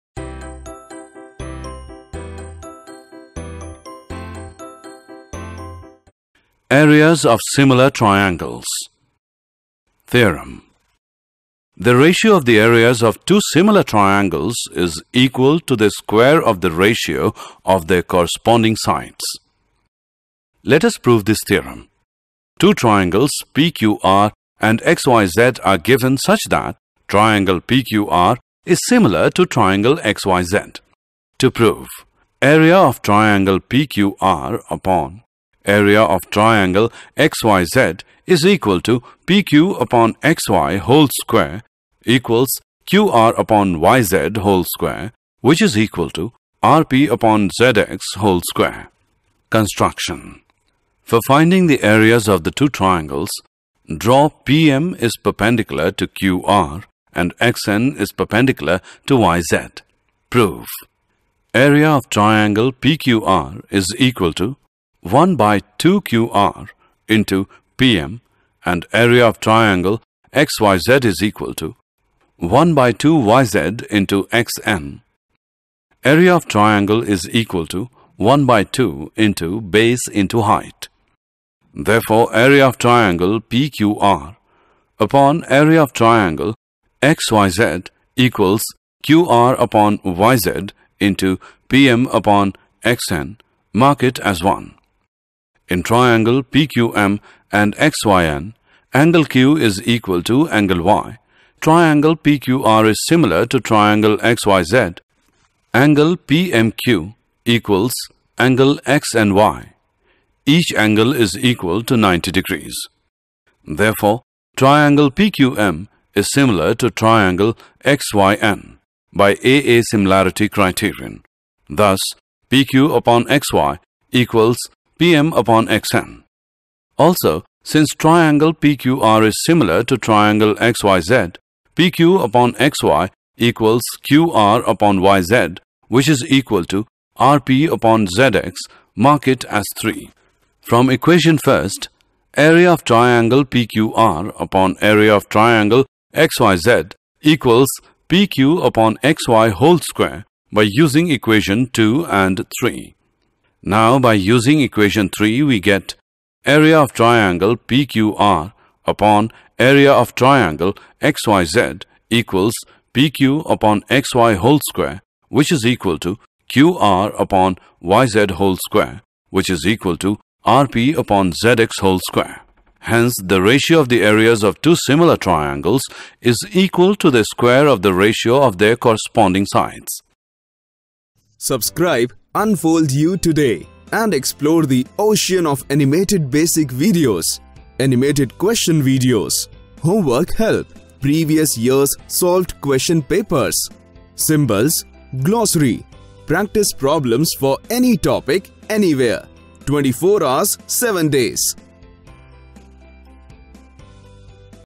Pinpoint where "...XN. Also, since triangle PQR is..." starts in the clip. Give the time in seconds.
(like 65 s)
125 s.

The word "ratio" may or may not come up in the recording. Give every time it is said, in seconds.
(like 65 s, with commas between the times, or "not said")
11 s, 16 s, 173 s, 177 s.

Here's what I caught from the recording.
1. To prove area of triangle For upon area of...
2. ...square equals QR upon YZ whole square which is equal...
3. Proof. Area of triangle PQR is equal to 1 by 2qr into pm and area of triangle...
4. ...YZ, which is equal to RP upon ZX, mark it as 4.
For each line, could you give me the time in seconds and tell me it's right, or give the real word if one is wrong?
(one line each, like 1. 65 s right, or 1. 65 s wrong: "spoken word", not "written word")
1. 31 s wrong: "PQR", not "For"
2. 41 s right
3. 60 s right
4. 134 s wrong: "3", not "4".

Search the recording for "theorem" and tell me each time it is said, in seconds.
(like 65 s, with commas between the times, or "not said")
10 s, 21 s.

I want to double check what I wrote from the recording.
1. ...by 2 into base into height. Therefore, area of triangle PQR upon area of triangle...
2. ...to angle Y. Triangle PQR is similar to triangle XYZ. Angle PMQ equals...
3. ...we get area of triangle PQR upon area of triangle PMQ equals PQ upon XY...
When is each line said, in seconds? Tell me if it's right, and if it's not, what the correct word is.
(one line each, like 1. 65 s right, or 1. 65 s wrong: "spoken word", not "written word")
1. 78 s right
2. 100 s right
3. 155 s wrong: "XYZ", not "PMQ".